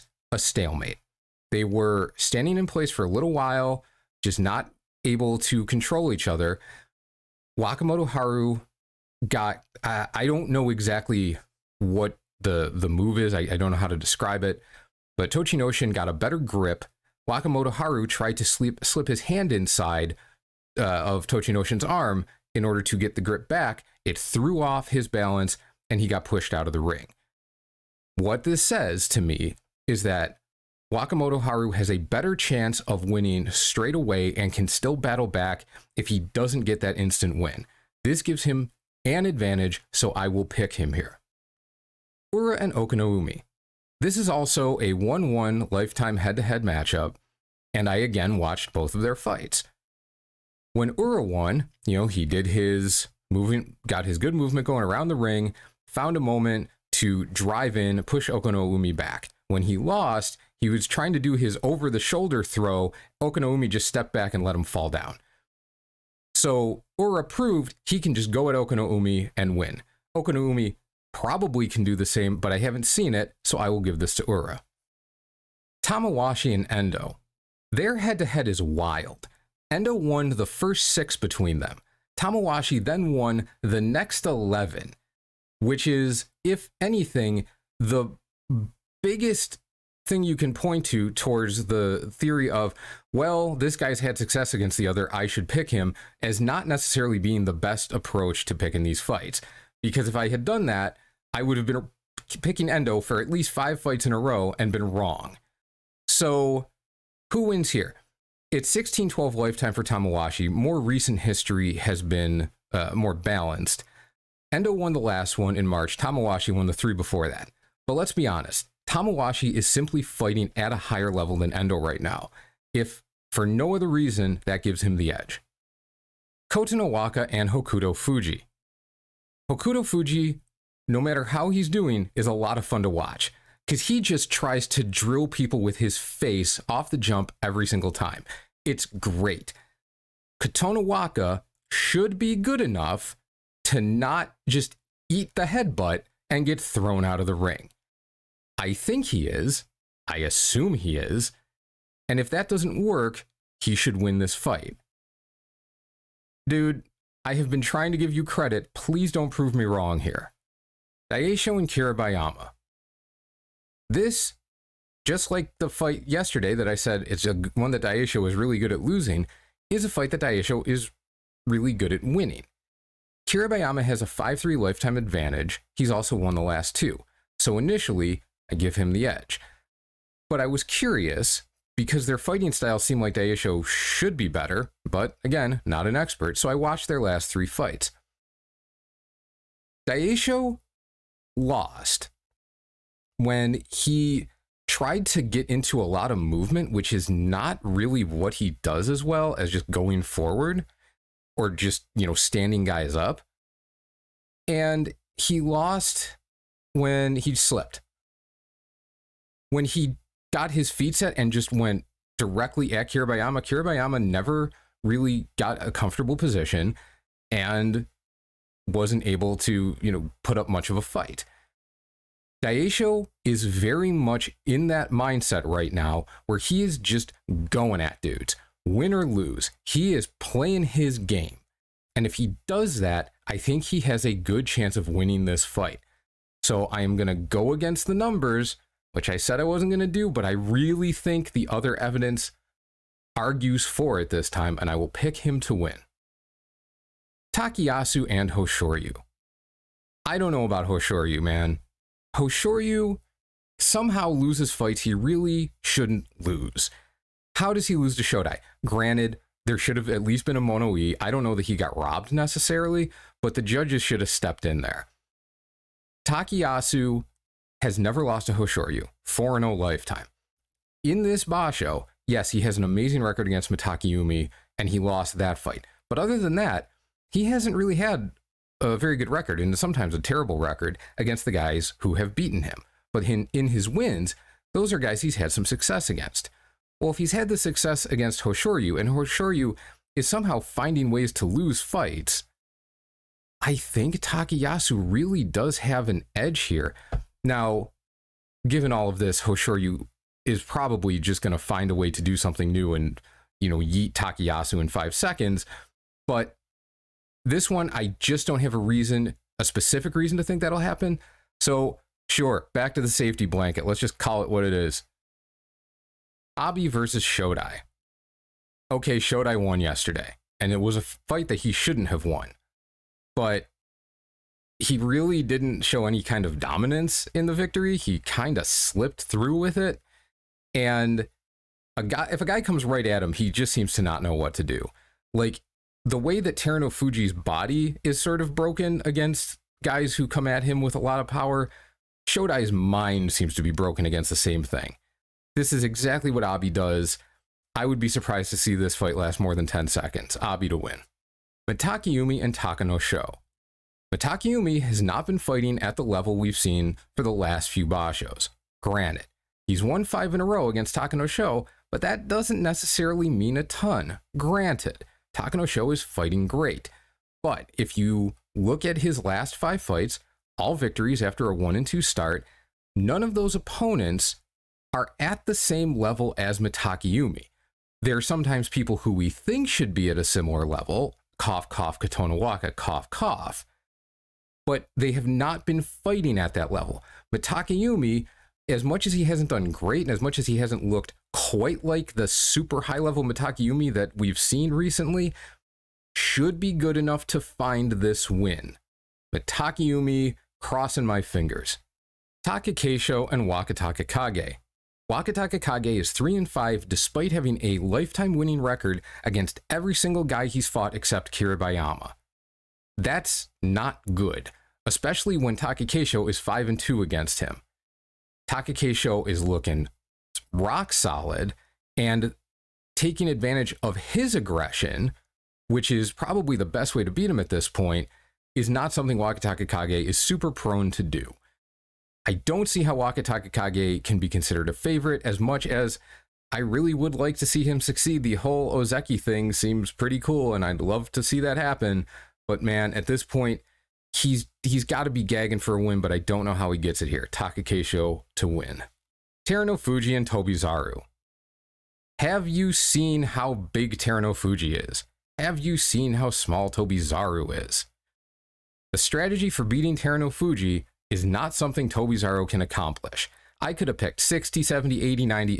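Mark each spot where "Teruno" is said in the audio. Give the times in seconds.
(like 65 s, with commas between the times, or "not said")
336 s, 449 s, 453 s.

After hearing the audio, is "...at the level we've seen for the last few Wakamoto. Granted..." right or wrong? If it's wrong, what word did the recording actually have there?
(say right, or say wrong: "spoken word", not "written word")
wrong: "Bashos", not "Wakamoto".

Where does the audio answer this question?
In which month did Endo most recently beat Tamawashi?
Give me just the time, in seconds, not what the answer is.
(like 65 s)
115 s.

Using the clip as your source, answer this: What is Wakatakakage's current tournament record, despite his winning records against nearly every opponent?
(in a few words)
3 and 5.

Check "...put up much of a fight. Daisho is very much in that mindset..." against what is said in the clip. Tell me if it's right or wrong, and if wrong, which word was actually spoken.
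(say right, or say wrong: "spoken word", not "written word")
right.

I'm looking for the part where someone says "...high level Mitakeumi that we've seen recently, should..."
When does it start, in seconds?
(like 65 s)
392 s.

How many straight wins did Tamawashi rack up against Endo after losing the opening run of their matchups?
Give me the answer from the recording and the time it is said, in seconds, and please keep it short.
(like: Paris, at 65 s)
11, at 83 s.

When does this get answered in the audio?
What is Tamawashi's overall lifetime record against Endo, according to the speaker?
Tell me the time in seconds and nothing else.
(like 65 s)
108 s.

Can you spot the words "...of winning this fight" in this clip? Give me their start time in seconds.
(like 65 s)
234 s.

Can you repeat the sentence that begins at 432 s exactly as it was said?
I don't see how Wakataka Kage can be considered a favorite as much as I really would like to see him succeed.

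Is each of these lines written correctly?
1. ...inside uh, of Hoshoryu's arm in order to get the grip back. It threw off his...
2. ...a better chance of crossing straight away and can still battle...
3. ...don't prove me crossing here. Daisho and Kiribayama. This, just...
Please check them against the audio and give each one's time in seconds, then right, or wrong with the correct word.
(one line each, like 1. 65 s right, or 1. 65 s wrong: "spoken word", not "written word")
1. 19 s wrong: "Tochinoshin", not "Hoshoryu"
2. 31 s wrong: "winning", not "crossing"
3. 159 s wrong: "wrong", not "crossing".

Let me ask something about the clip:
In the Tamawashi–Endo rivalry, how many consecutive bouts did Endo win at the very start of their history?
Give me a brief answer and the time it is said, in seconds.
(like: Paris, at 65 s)
6, at 79 s.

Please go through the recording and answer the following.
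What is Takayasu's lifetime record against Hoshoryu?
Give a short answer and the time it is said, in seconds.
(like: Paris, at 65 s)
4-0, at 269 s.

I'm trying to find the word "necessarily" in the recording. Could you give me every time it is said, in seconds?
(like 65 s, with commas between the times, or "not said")
96 s, 262 s, 362 s.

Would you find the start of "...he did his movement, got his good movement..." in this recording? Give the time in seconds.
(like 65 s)
52 s.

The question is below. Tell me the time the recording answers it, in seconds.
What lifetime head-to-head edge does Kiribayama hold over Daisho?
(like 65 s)
174 s.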